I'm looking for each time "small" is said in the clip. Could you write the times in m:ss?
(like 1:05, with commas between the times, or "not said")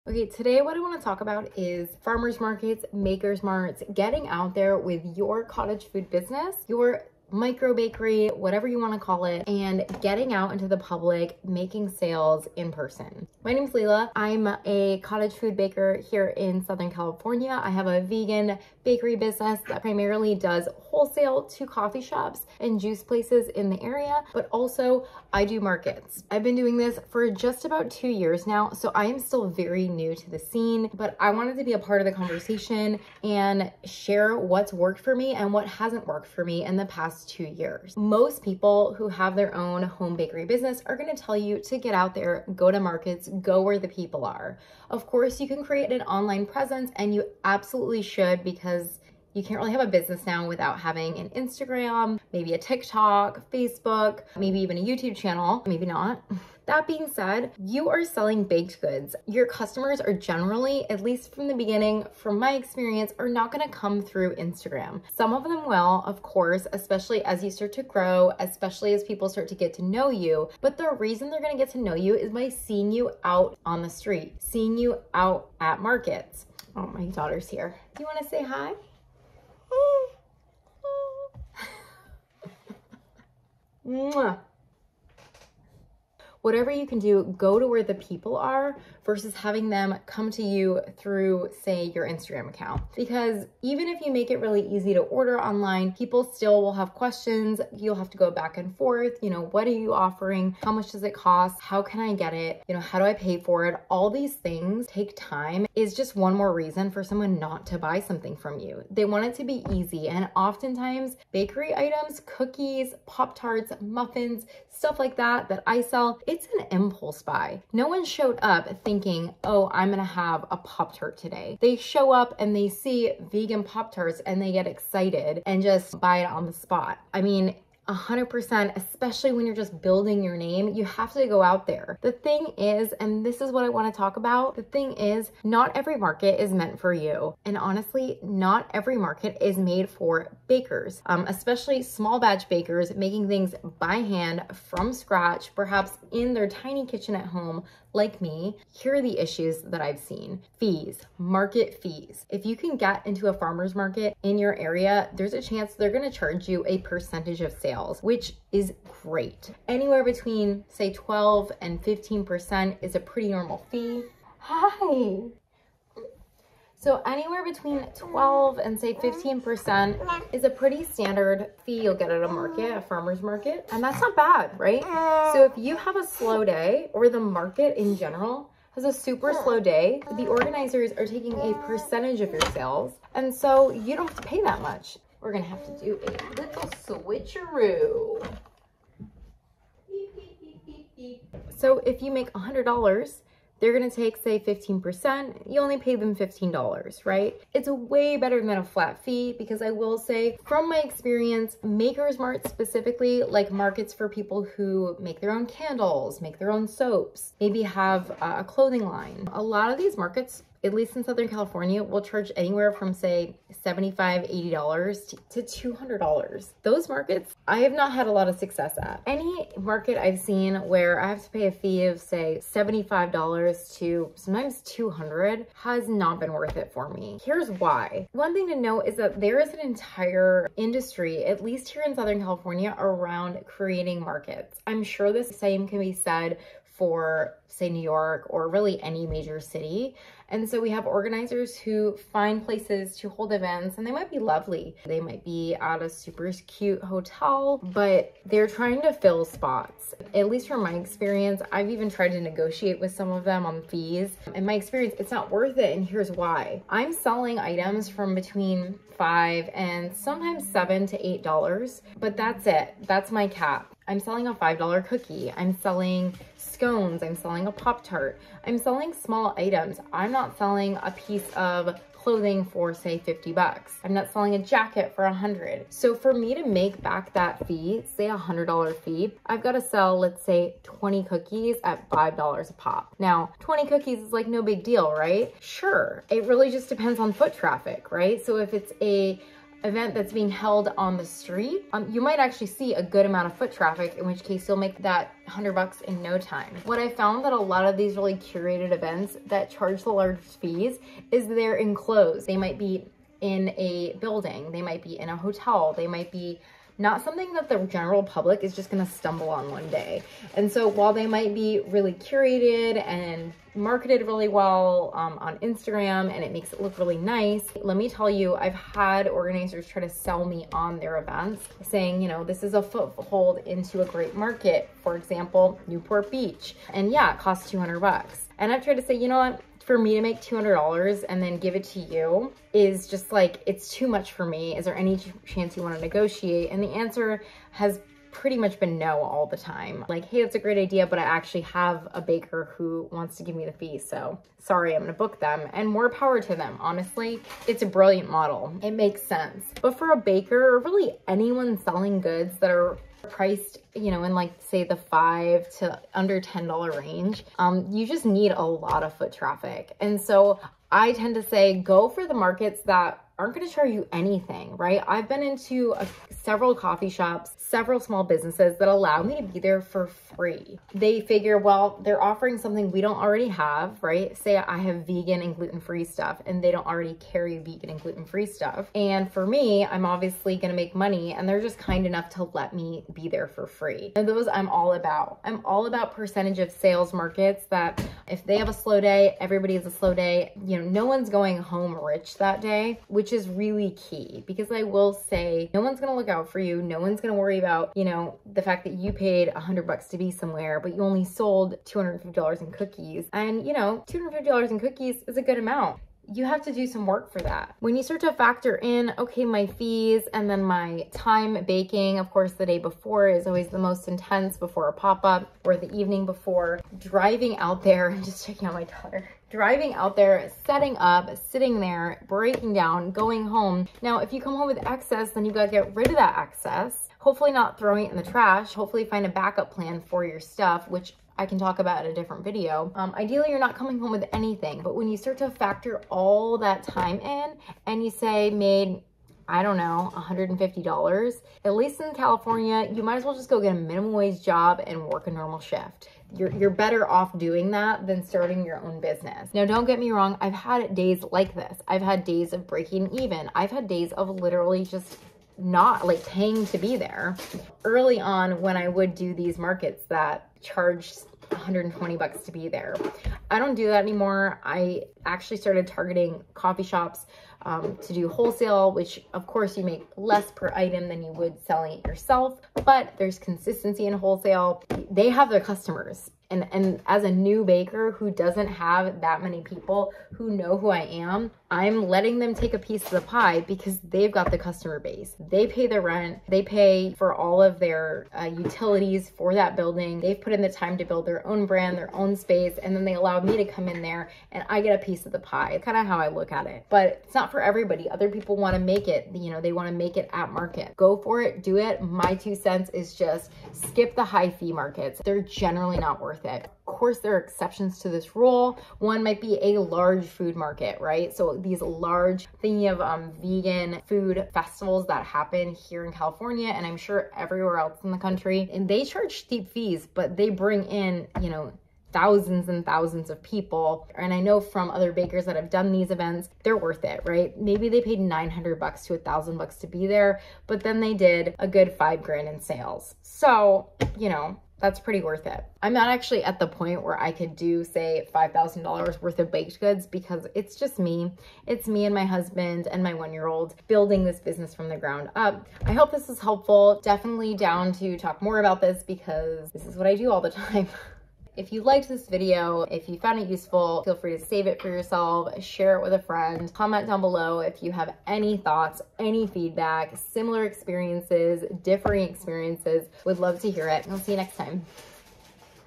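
2:21, 4:28, 6:07.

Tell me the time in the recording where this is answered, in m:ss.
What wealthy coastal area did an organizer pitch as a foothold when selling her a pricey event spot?
5:25.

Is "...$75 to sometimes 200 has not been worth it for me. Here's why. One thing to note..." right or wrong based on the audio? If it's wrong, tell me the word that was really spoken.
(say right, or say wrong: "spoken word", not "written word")
right.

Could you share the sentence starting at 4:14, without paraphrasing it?
In my experience, it's not worth it and here's why.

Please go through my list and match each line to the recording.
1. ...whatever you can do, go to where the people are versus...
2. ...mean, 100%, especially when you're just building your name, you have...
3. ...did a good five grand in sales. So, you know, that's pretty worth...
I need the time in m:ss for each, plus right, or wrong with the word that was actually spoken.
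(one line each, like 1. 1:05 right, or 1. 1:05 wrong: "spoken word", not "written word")
1. 1:26 right
2. 2:07 right
3. 8:50 right.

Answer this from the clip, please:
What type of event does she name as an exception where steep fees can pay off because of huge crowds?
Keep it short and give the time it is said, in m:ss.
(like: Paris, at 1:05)
vegan food festivals, at 8:33.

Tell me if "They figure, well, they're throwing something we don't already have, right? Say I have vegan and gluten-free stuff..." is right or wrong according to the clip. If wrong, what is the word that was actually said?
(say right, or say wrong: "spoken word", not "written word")
wrong: "offering", not "throwing".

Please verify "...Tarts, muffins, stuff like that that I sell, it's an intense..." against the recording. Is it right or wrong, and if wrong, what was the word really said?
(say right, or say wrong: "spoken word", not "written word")
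wrong: "impulse", not "intense".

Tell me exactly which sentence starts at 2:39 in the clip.
Anywhere between say 12 and 15% is a pretty normal fee.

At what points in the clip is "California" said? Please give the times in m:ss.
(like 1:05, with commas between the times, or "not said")
0:16, 3:31, 3:52, 7:21, 8:35.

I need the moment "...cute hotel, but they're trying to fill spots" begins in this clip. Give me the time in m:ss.
4:06.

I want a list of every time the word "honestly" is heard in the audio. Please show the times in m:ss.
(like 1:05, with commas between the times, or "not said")
2:17, 5:46.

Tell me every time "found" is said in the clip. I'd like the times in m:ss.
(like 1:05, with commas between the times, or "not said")
4:56, 9:12.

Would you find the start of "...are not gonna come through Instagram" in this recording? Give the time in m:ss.
1:03.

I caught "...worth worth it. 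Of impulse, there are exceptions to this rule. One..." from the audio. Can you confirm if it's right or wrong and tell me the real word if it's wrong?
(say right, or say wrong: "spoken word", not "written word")
wrong: "course", not "impulse".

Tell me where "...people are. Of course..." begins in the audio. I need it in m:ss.
0:43.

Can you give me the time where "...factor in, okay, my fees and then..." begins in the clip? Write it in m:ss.
6:48.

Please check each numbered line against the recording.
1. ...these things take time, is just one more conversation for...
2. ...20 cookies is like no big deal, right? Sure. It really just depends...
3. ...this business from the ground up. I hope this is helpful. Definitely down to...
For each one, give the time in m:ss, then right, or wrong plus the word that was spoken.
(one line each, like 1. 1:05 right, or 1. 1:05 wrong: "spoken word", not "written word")
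1. 1:44 wrong: "reason", not "conversation"
2. 4:43 right
3. 9:04 right.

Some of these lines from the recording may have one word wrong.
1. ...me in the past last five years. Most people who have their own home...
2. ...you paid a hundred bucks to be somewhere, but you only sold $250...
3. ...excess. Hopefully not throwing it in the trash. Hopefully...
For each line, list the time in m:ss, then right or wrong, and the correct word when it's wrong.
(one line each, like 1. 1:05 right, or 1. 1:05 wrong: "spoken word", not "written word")
1. 0:36 wrong: "two", not "five"
2. 6:38 right
3. 7:06 right.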